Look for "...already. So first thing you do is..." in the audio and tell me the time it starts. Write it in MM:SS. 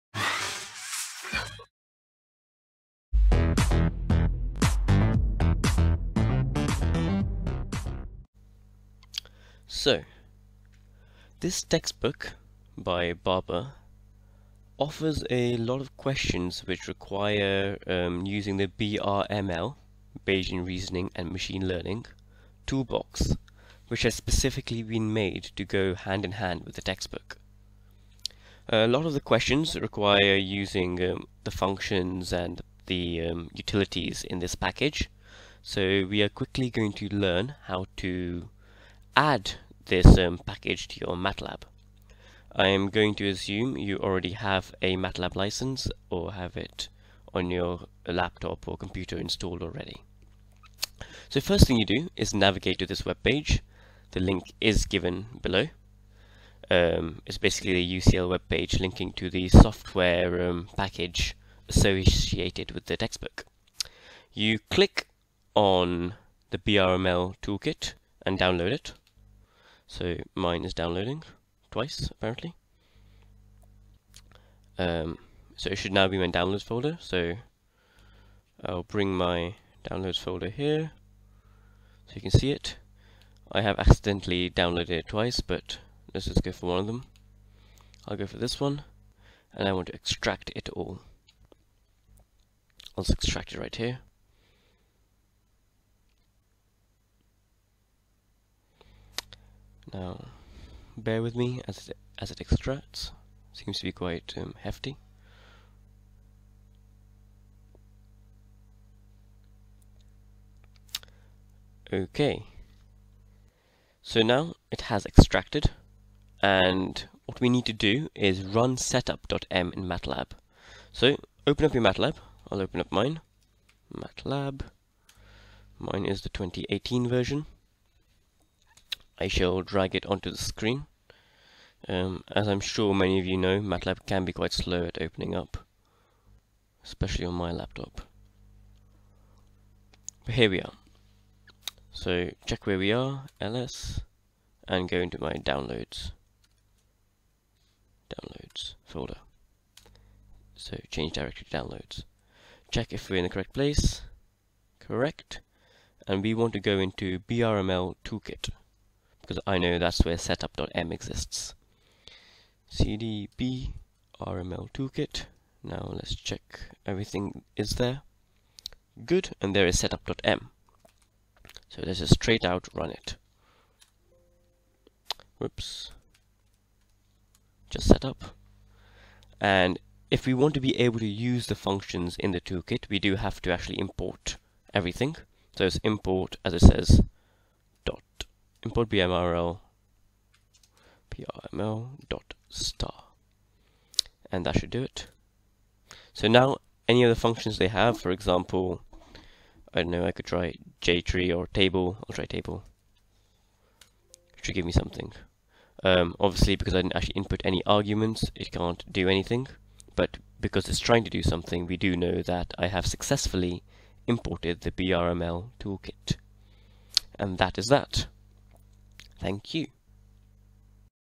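00:49.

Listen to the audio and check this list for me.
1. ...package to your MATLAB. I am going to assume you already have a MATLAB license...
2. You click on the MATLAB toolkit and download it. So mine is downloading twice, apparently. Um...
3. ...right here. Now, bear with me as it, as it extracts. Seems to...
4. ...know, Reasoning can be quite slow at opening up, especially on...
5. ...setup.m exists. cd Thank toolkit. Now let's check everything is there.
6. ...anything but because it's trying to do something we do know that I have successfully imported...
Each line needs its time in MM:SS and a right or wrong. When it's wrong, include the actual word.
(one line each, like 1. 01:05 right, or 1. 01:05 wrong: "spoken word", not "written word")
1. 00:40 right
2. 01:04 wrong: "BRML", not "MATLAB"
3. 01:33 right
4. 02:13 wrong: "MATLAB", not "Reasoning"
5. 02:40 wrong: "BRML", not "Thank"
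6. 03:29 right.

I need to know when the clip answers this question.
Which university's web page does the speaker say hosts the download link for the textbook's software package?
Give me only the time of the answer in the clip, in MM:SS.
00:57.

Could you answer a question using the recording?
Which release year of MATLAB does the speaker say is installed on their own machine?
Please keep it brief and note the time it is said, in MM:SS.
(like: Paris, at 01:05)
2018, at 02:06.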